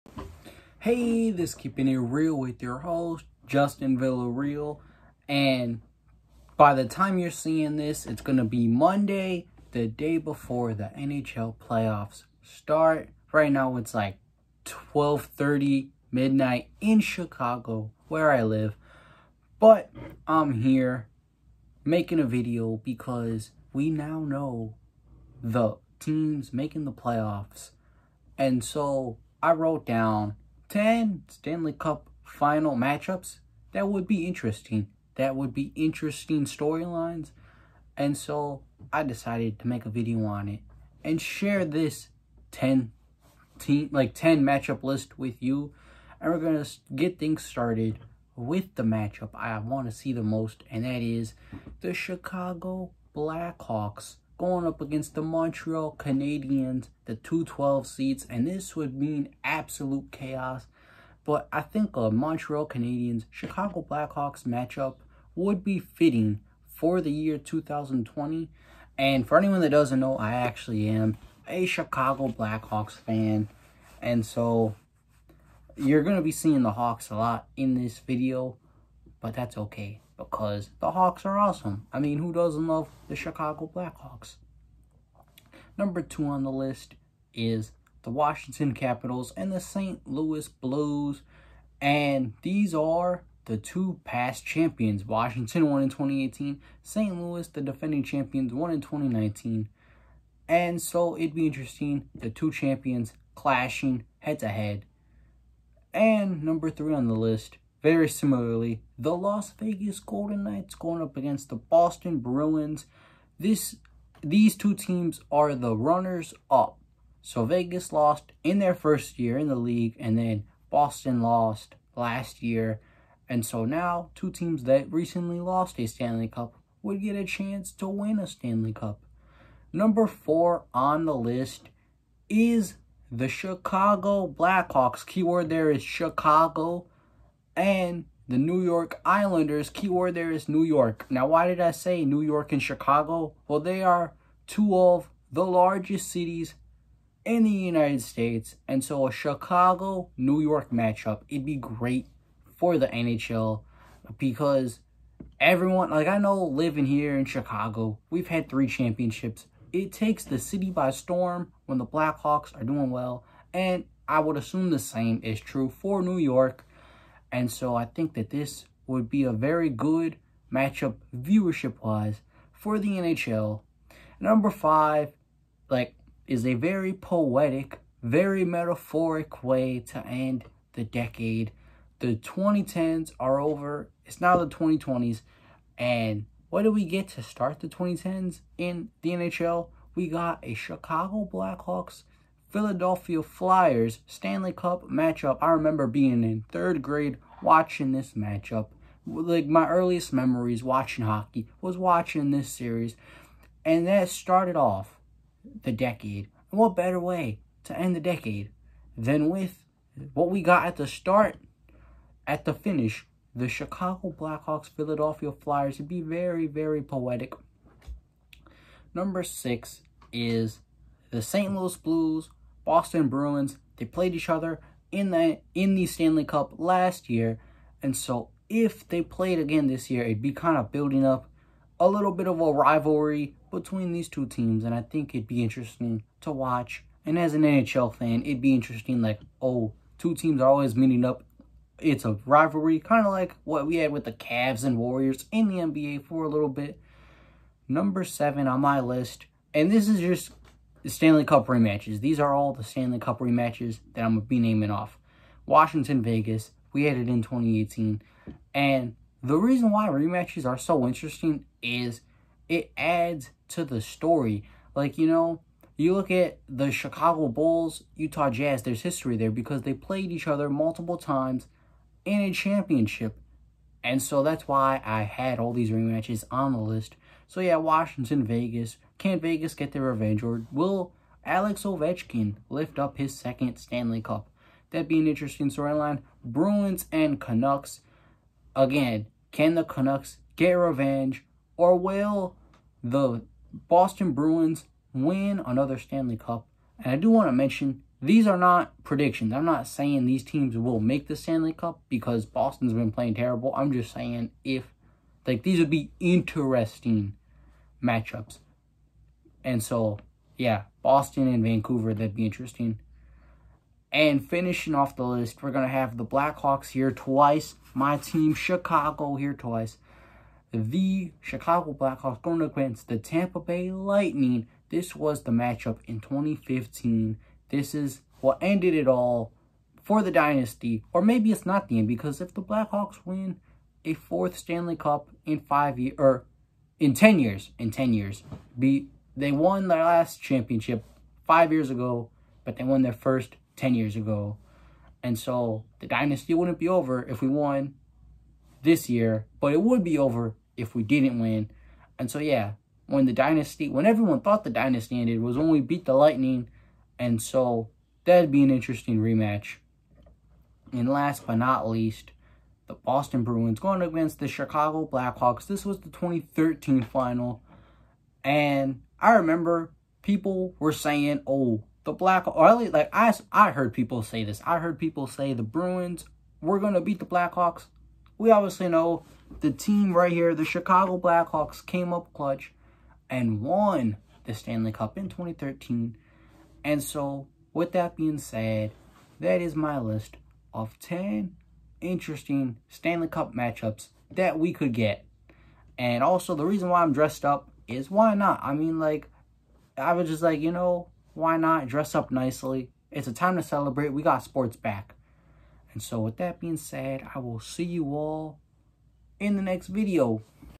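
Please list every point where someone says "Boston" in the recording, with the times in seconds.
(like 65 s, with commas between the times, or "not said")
111 s, 120 s, 222 s, 293 s, 302 s, 310 s, 362 s.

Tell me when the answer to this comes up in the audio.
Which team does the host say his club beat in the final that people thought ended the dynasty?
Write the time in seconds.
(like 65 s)
322 s.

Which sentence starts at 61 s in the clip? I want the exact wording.
But I think a Montreal Canadiens Chicago Blackhawks matchup would be fitting for the year 2020.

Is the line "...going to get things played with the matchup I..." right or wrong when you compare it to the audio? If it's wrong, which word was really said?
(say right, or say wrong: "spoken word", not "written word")
wrong: "started", not "played".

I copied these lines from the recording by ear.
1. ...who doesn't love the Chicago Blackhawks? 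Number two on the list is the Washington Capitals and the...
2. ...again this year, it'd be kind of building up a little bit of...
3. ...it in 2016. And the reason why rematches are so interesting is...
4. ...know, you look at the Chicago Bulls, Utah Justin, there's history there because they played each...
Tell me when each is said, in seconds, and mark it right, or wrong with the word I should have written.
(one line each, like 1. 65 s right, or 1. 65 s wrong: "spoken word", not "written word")
1. 82 s right
2. 229 s right
3. 256 s wrong: "2018", not "2016"
4. 265 s wrong: "Jazz", not "Justin".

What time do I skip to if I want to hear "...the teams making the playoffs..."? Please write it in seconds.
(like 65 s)
25 s.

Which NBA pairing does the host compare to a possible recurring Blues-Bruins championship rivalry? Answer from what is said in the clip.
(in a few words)
Cavs and Warriors.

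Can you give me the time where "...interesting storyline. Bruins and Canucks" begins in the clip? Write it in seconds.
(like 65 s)
285 s.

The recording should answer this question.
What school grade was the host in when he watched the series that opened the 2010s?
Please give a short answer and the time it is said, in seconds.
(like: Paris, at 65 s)
Third grade, at 196 s.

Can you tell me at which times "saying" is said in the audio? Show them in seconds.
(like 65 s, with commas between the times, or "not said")
299 s, 303 s, 370 s.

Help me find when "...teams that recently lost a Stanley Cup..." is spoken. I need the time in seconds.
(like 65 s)
124 s.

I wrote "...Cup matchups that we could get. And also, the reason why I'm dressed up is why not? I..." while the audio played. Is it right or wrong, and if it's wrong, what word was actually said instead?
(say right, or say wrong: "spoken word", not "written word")
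right.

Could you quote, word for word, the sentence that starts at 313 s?
And finishing off the list, we're going to have the Blackhawks here twice.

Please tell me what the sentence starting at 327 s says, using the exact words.
This is what ended it all for the dynasty.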